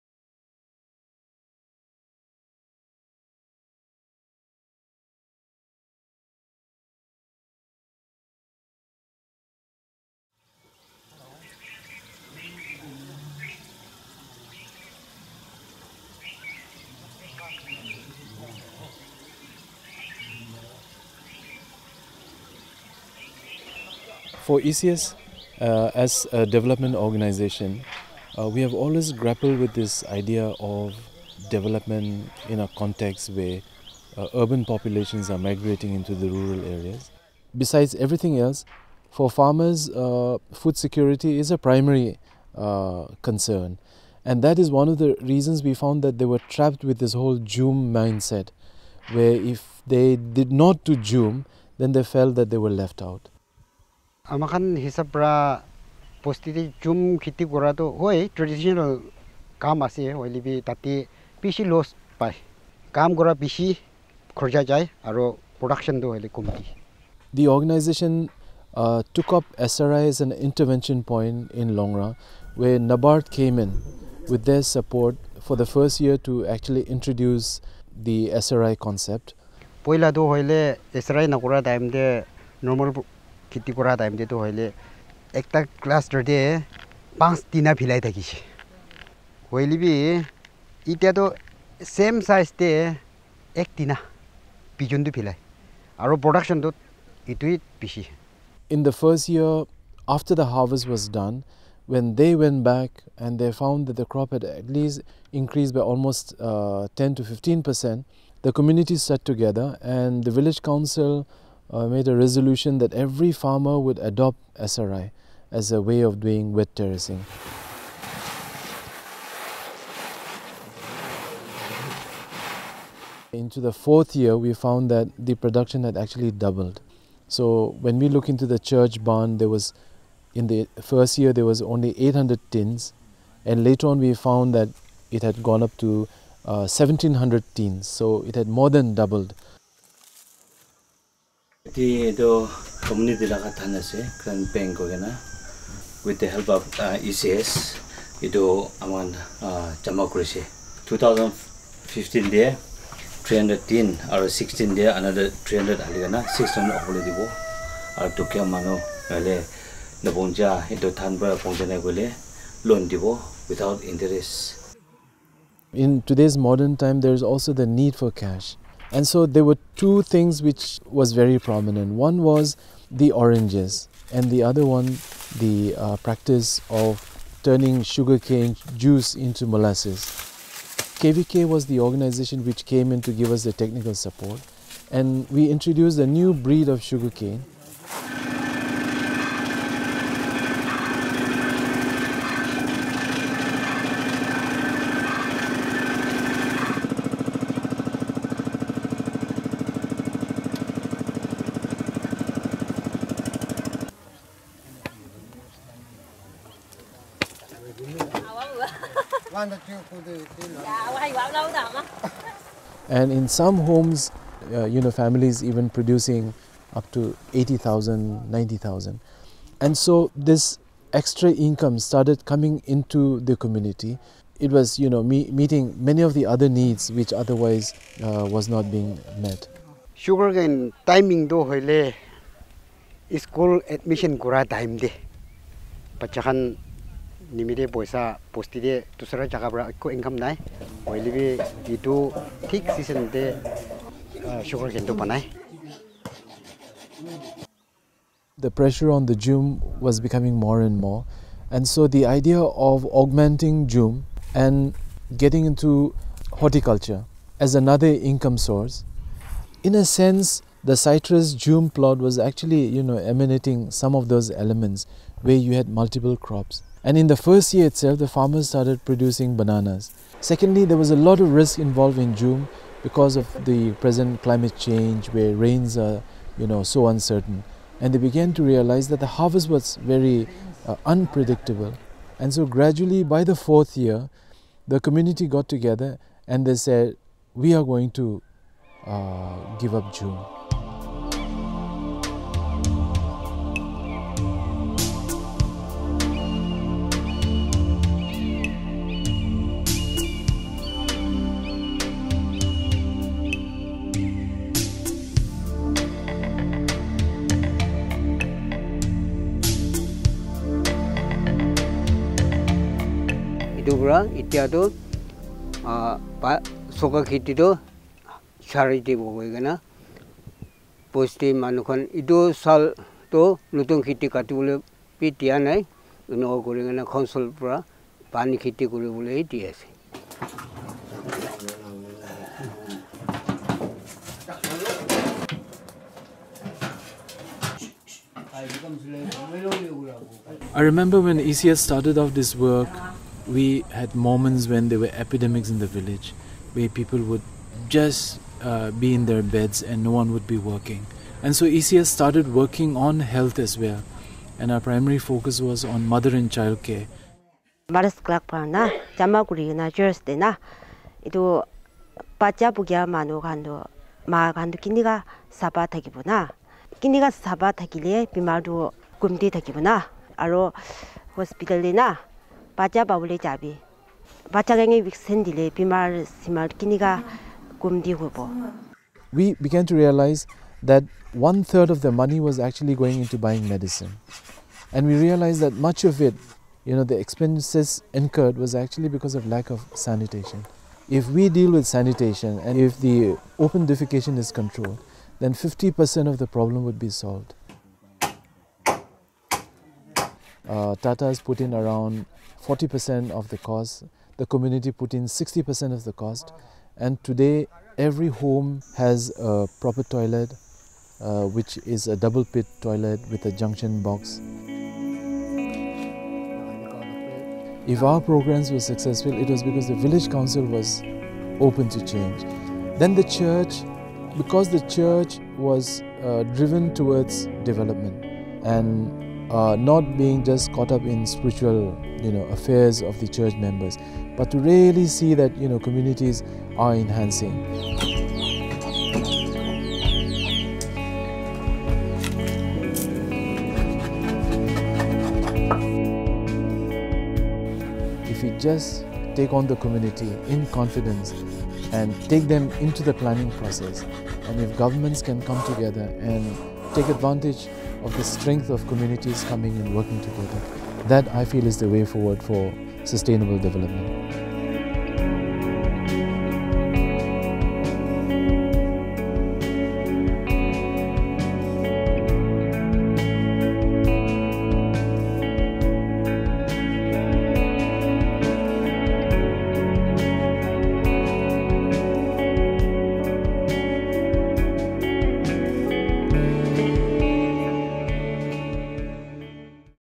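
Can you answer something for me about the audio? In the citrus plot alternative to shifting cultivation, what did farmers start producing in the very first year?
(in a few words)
Bananas.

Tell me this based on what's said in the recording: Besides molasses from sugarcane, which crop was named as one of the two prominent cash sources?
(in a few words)
Oranges.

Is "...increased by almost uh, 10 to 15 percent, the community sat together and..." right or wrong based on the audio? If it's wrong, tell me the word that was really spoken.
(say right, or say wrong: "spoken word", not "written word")
right.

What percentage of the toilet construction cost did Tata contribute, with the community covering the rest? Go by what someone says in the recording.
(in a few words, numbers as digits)
40%.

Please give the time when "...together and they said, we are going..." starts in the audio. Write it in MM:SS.
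04:45.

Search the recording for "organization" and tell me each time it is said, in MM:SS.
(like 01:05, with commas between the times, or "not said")
00:26, 03:01.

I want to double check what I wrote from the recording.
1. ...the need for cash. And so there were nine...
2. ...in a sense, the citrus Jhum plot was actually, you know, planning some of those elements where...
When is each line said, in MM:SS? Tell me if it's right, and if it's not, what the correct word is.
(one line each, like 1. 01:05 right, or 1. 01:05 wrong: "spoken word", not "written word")
1. 02:47 wrong: "two", not "nine"
2. 04:19 wrong: "emanating", not "planning".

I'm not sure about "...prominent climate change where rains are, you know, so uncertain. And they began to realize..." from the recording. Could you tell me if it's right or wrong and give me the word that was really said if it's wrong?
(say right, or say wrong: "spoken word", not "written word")
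wrong: "present", not "prominent".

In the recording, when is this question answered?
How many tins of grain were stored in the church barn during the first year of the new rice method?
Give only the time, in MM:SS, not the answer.
02:11.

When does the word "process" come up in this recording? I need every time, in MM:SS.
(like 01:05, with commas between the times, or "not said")
07:33.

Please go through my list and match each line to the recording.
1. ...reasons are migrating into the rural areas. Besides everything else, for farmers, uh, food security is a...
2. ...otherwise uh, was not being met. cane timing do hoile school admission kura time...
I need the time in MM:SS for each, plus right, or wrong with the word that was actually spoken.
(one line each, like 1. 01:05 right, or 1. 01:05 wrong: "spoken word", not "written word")
1. 00:34 wrong: "populations", not "reasons"
2. 03:47 right.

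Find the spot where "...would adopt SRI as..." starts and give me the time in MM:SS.
01:53.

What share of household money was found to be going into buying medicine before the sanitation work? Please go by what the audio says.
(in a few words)
One third.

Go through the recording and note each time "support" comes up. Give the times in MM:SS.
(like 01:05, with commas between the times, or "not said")
03:03.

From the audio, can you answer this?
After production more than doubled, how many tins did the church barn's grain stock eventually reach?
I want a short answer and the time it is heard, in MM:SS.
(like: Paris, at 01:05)
1700 tins, at 02:16.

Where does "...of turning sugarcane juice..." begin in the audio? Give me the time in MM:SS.
02:56.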